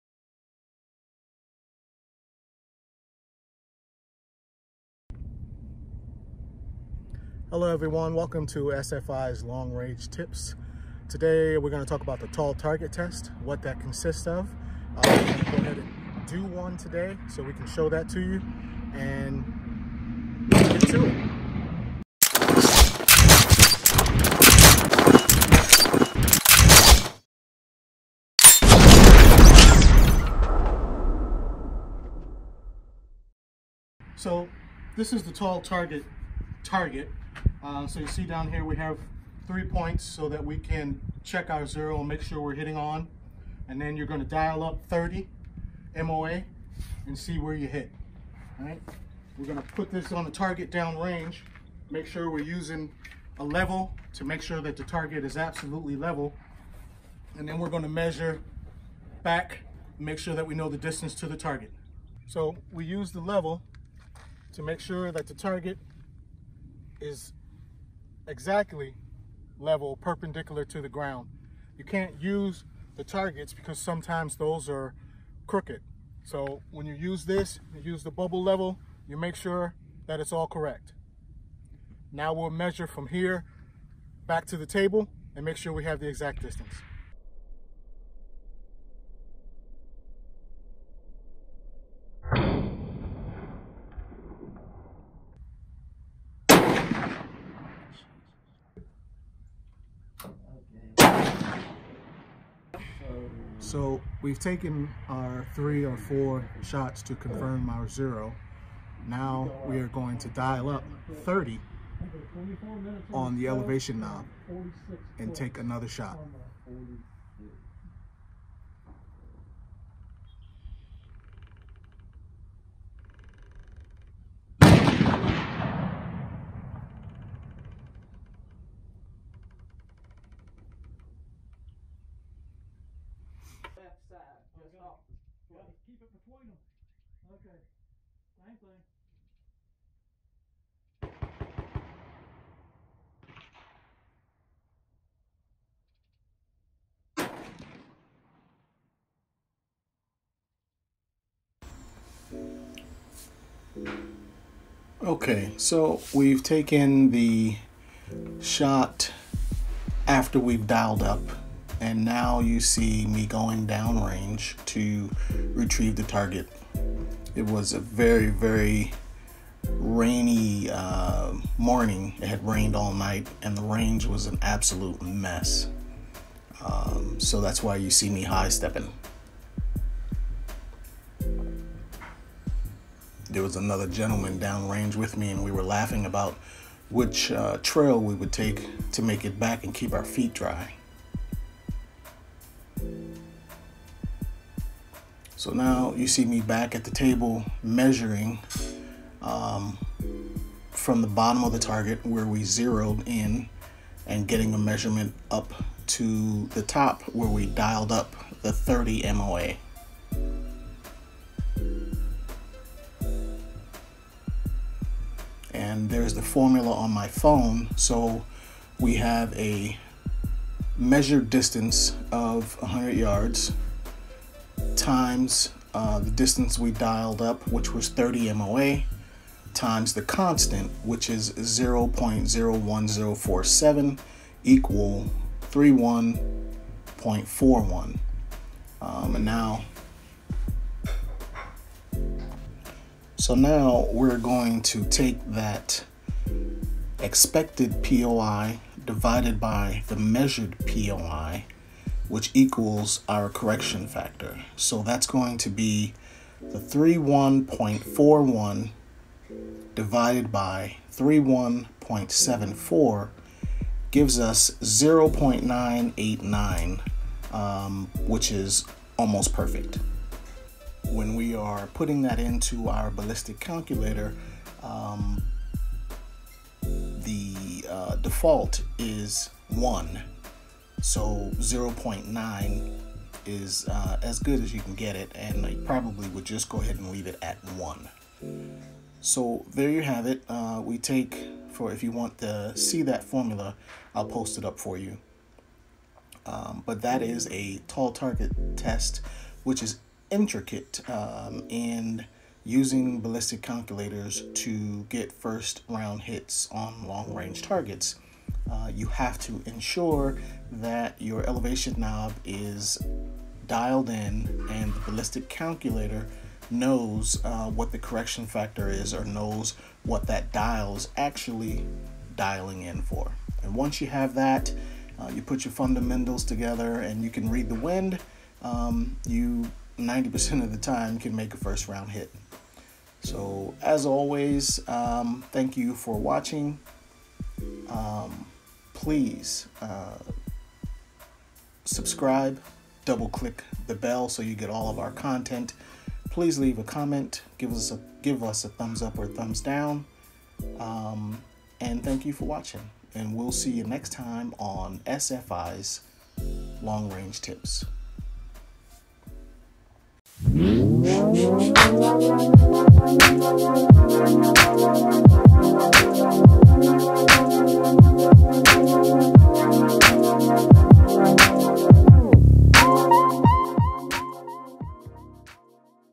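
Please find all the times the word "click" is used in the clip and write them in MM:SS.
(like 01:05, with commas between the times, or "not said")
05:43.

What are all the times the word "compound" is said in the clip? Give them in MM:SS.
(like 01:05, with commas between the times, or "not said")
not said.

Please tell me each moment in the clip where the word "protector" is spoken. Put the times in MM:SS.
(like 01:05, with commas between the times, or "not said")
not said.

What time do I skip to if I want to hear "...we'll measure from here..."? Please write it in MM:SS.
01:22.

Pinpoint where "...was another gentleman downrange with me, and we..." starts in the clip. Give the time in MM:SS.
03:03.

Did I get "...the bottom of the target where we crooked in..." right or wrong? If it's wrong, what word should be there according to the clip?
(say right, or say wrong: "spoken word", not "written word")
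wrong: "zeroed", not "crooked".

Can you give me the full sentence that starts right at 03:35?
And there's the formula on my phone.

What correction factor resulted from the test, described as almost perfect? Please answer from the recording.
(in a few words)
0.989.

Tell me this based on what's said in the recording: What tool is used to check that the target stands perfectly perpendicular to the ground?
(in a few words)
bubble level.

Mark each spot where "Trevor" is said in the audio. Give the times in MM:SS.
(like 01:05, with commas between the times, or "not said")
not said.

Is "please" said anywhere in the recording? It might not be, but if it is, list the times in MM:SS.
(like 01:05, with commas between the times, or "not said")
05:38, 05:46.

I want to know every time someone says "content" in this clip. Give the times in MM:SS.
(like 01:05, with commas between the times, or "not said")
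05:44.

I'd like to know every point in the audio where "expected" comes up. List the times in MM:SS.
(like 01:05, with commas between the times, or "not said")
04:06.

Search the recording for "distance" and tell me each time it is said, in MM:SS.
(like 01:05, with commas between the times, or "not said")
01:00, 01:26, 03:41, 03:46.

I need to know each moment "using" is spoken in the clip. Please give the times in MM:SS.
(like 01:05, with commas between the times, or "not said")
00:52, 05:02.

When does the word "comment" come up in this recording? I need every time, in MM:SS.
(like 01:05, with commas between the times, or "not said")
05:46.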